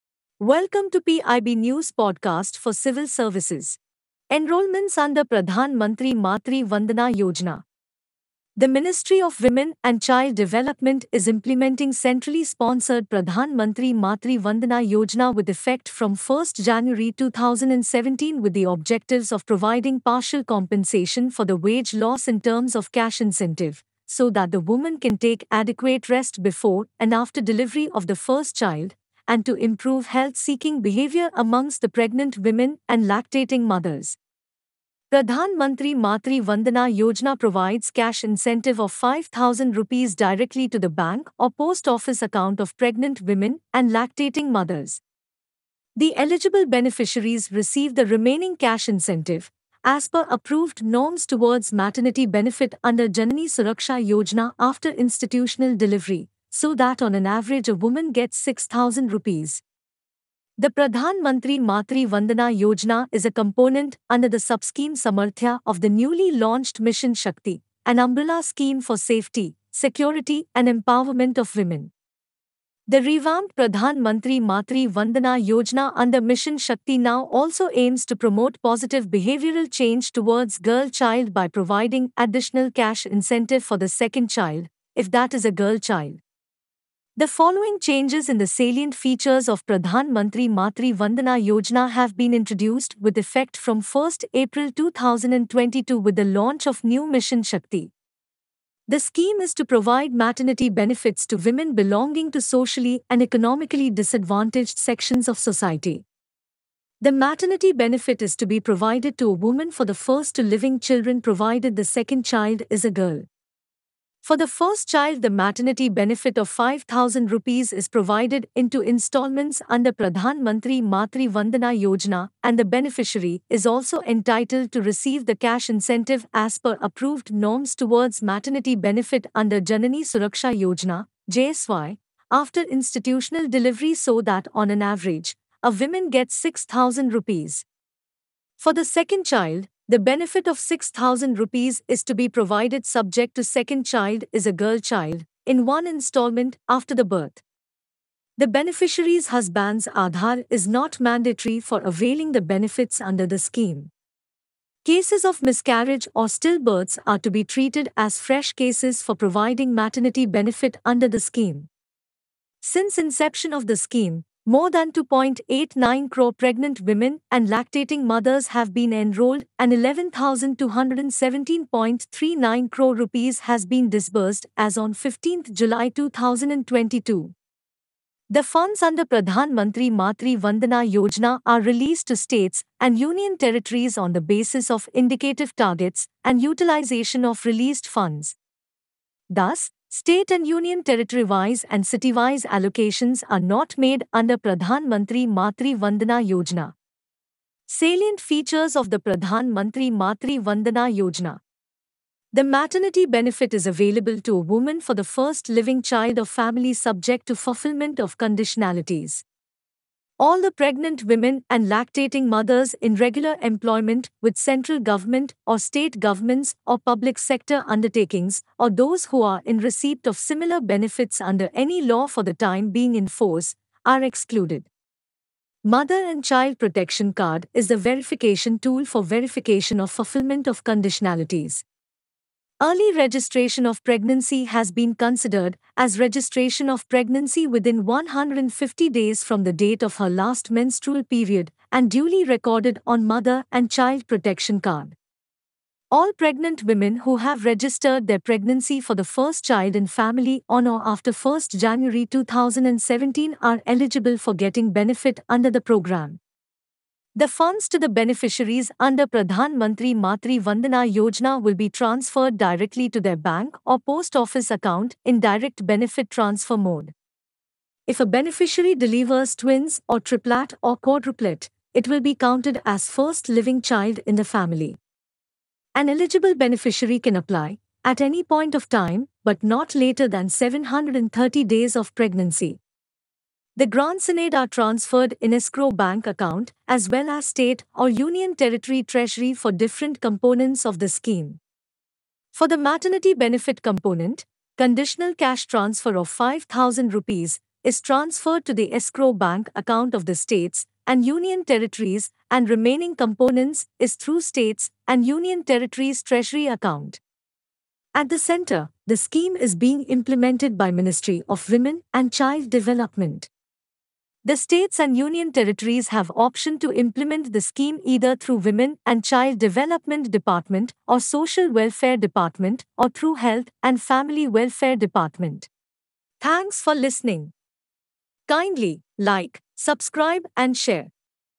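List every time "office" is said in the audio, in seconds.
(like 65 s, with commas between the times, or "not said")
41 s, 264 s.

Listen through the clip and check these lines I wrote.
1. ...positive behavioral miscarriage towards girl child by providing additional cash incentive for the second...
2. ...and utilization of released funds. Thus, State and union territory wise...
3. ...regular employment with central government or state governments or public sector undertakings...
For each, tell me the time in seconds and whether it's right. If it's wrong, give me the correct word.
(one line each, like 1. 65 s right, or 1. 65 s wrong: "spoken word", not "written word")
1. 78 s wrong: "change", not "miscarriage"
2. 186 s right
3. 212 s right.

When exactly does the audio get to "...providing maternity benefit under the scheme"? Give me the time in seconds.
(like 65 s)
159 s.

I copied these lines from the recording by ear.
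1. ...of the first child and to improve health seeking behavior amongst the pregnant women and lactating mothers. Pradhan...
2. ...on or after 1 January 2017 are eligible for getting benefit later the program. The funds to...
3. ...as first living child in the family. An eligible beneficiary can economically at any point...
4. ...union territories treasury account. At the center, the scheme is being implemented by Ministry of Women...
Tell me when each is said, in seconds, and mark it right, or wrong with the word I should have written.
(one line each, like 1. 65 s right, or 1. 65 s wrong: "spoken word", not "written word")
1. 27 s right
2. 250 s wrong: "under", not "later"
3. 272 s wrong: "apply", not "economically"
4. 305 s right.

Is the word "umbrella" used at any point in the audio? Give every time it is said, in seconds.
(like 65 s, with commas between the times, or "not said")
67 s.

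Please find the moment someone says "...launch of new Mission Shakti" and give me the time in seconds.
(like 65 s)
96 s.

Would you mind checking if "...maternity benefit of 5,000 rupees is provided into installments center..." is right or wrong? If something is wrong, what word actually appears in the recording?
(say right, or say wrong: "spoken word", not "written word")
wrong: "under", not "center".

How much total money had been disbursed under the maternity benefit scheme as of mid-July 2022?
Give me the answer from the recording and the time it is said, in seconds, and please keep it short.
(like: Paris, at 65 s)
11,217.39 crore rupees, at 169 s.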